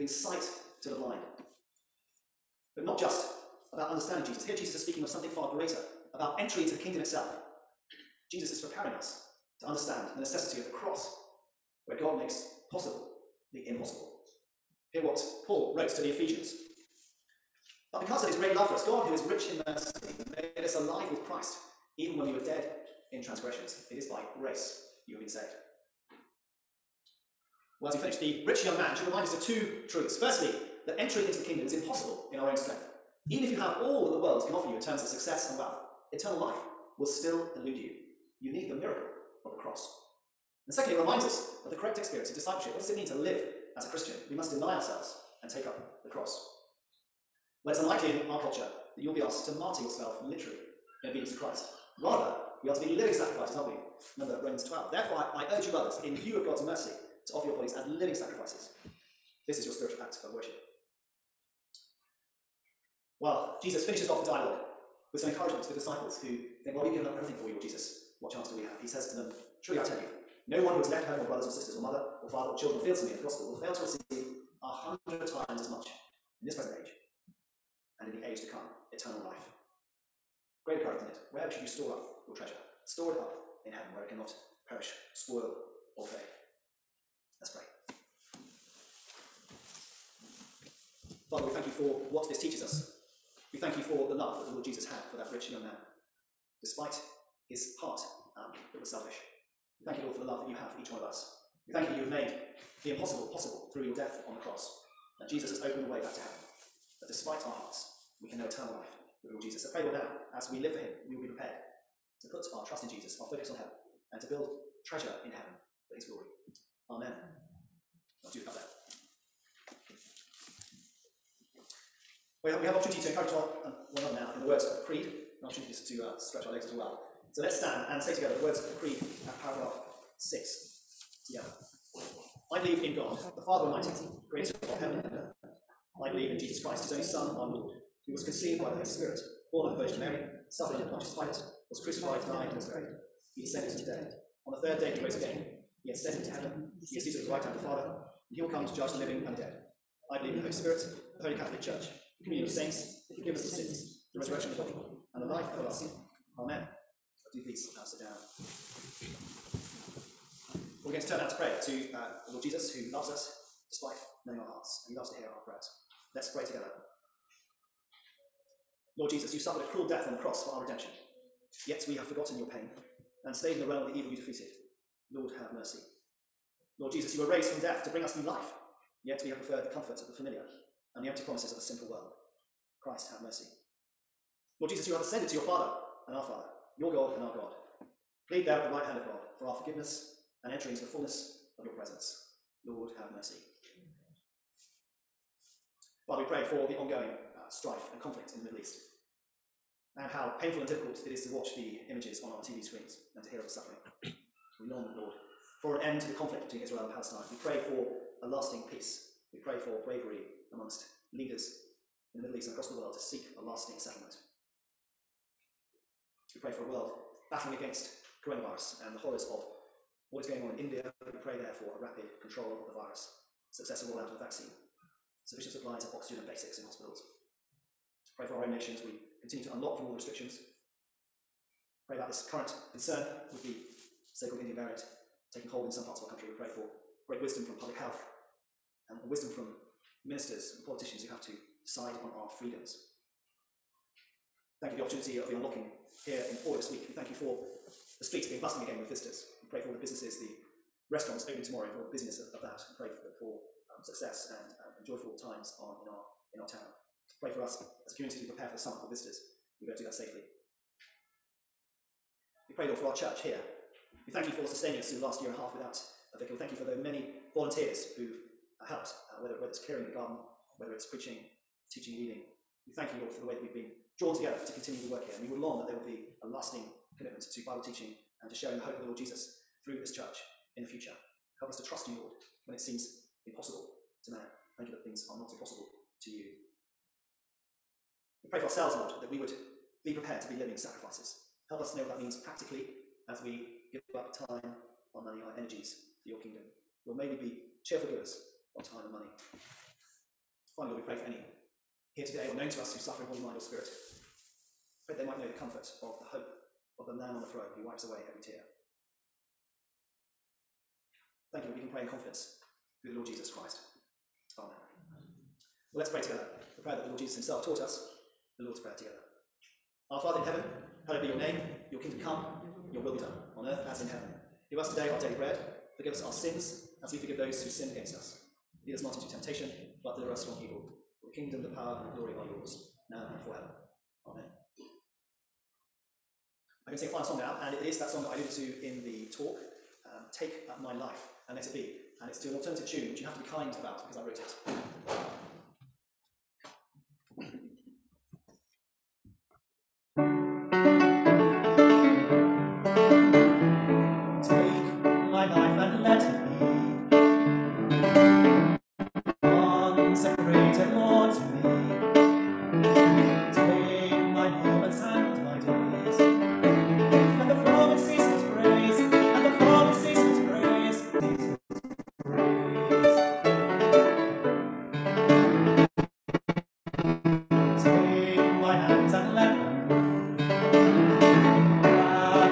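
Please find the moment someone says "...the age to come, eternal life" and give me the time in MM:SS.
01:18.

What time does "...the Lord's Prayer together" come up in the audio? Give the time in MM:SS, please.
05:18.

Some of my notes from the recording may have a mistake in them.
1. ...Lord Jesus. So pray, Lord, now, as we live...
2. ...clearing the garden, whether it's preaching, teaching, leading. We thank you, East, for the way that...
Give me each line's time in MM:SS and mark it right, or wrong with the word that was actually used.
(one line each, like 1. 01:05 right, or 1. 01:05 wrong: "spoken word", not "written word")
1. 01:49 right
2. 04:29 wrong: "Lord", not "East".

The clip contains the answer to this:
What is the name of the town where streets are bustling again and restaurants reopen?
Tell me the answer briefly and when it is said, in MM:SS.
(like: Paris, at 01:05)
Fowey, at 04:06.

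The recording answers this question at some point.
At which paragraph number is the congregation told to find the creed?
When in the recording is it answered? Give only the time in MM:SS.
02:09.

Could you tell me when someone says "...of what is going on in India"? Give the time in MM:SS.
03:39.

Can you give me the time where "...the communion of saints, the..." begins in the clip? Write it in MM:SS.
02:32.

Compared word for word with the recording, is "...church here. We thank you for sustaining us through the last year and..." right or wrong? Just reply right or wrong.
right.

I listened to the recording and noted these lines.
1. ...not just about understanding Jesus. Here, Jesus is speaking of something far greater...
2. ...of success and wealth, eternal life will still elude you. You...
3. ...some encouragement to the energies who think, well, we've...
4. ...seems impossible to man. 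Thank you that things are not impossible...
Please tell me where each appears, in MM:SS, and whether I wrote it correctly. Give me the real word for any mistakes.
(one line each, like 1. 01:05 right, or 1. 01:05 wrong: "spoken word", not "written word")
1. 00:02 right
2. 00:35 right
3. 01:05 wrong: "disciples", not "energies"
4. 04:42 right.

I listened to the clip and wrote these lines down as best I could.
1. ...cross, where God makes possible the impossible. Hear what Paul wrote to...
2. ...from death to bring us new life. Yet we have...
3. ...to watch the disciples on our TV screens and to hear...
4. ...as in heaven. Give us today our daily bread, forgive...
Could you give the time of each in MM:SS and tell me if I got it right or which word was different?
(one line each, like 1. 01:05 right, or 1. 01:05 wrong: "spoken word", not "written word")
1. 00:10 right
2. 02:57 right
3. 03:21 wrong: "images", not "disciples"
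4. 05:23 right.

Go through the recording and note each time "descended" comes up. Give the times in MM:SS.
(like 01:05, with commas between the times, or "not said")
02:23.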